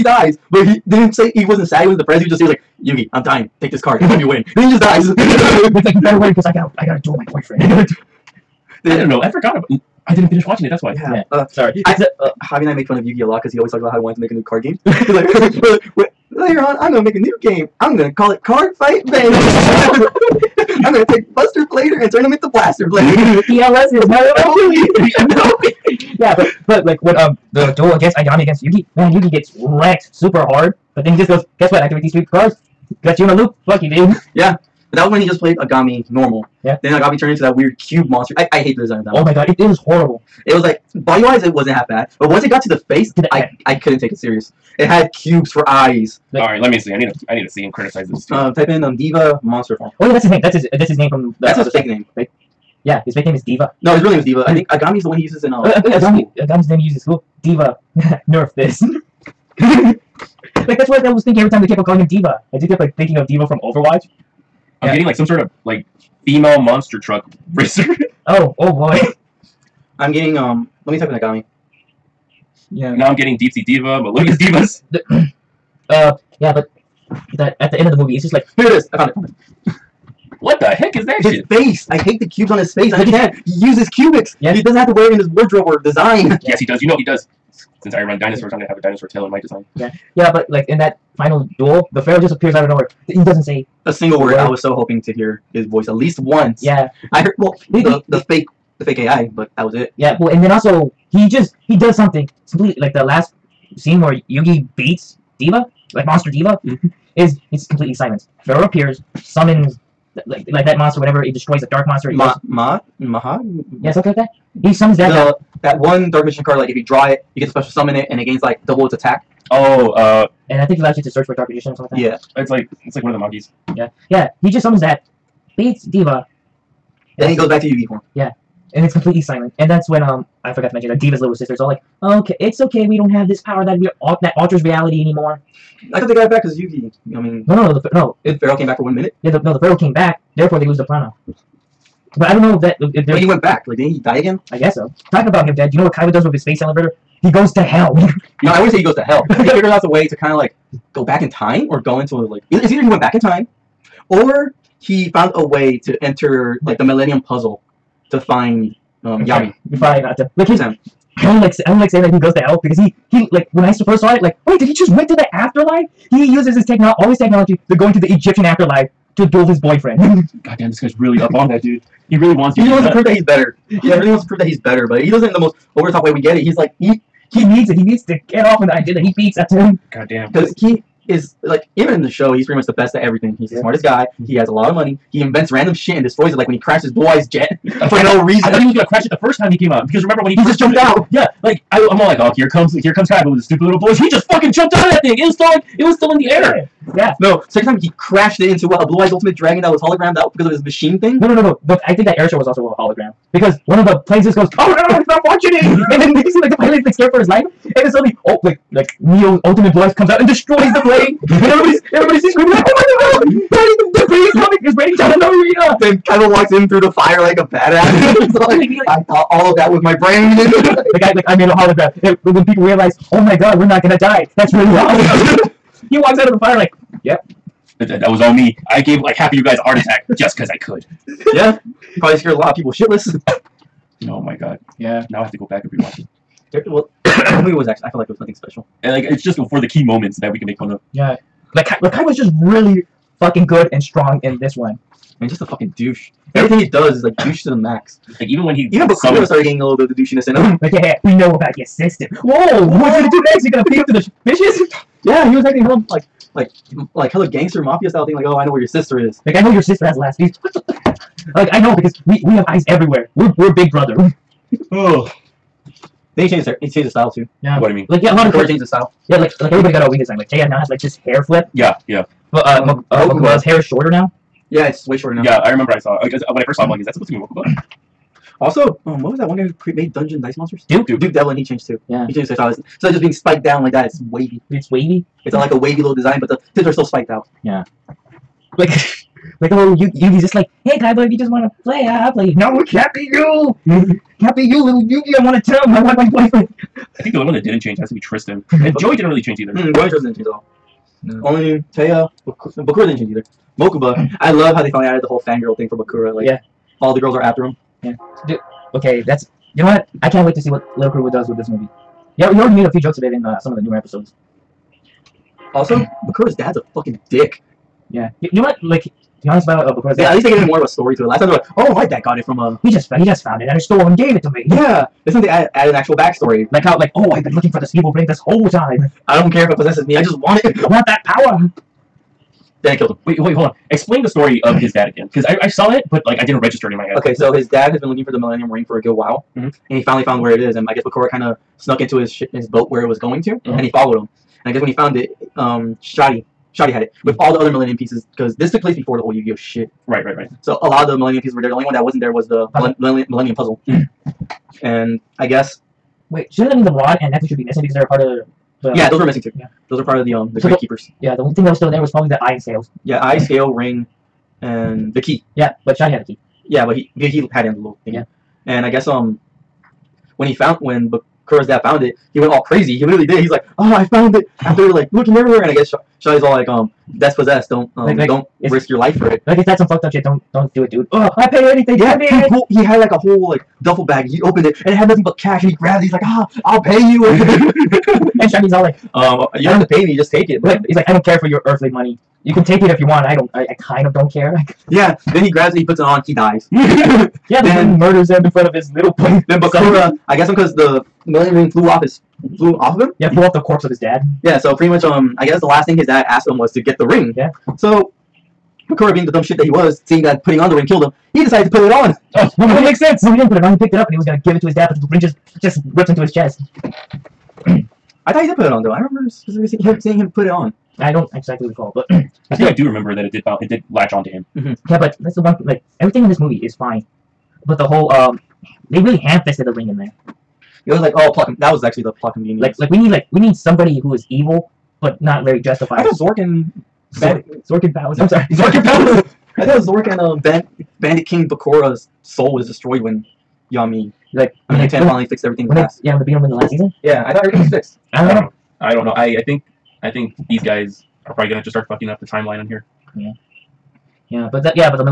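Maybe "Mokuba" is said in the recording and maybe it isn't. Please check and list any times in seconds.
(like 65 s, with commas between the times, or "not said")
273 s, 277 s, 303 s.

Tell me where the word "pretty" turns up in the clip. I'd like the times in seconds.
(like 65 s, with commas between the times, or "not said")
182 s, 404 s.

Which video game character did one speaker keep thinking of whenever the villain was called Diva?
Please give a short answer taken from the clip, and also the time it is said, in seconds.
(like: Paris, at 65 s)
D.Va, at 57 s.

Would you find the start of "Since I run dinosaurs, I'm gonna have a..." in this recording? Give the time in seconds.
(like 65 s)
87 s.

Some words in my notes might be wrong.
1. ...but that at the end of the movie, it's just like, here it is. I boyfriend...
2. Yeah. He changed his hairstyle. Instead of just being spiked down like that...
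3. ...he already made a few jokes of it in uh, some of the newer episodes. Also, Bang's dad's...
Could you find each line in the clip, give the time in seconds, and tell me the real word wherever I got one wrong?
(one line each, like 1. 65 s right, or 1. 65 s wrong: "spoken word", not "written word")
1. 76 s wrong: "found", not "boyfriend"
2. 281 s right
3. 312 s wrong: "Bakura", not "Bang".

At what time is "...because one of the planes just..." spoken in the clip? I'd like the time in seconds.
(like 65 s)
203 s.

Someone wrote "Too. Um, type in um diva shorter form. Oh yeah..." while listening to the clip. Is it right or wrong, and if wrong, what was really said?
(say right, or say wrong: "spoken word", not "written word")
wrong: "monster", not "shorter".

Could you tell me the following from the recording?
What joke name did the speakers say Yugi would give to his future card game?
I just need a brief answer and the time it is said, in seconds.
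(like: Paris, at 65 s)
Card Fight Bang, at 18 s.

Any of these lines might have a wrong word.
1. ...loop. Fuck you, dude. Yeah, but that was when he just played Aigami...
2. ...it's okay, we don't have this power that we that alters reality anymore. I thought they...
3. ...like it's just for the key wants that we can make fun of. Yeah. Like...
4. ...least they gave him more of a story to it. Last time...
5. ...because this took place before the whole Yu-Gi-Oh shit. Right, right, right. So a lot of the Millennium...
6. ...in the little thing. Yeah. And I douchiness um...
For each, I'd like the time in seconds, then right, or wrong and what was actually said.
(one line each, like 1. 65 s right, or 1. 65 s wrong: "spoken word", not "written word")
1. 33 s right
2. 132 s right
3. 238 s wrong: "moments", not "wants"
4. 320 s right
5. 348 s right
6. 367 s wrong: "guess", not "douchiness".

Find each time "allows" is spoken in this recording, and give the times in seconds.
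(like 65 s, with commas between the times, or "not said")
120 s.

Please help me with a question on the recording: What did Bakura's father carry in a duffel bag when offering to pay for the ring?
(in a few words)
cash.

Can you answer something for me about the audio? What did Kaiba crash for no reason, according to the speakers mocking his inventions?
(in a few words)
Blue Eyes jet.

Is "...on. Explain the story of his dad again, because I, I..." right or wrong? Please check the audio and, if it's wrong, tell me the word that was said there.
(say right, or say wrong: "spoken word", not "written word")
right.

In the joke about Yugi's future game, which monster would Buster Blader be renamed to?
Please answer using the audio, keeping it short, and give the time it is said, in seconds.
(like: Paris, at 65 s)
Blaster Blader, at 22 s.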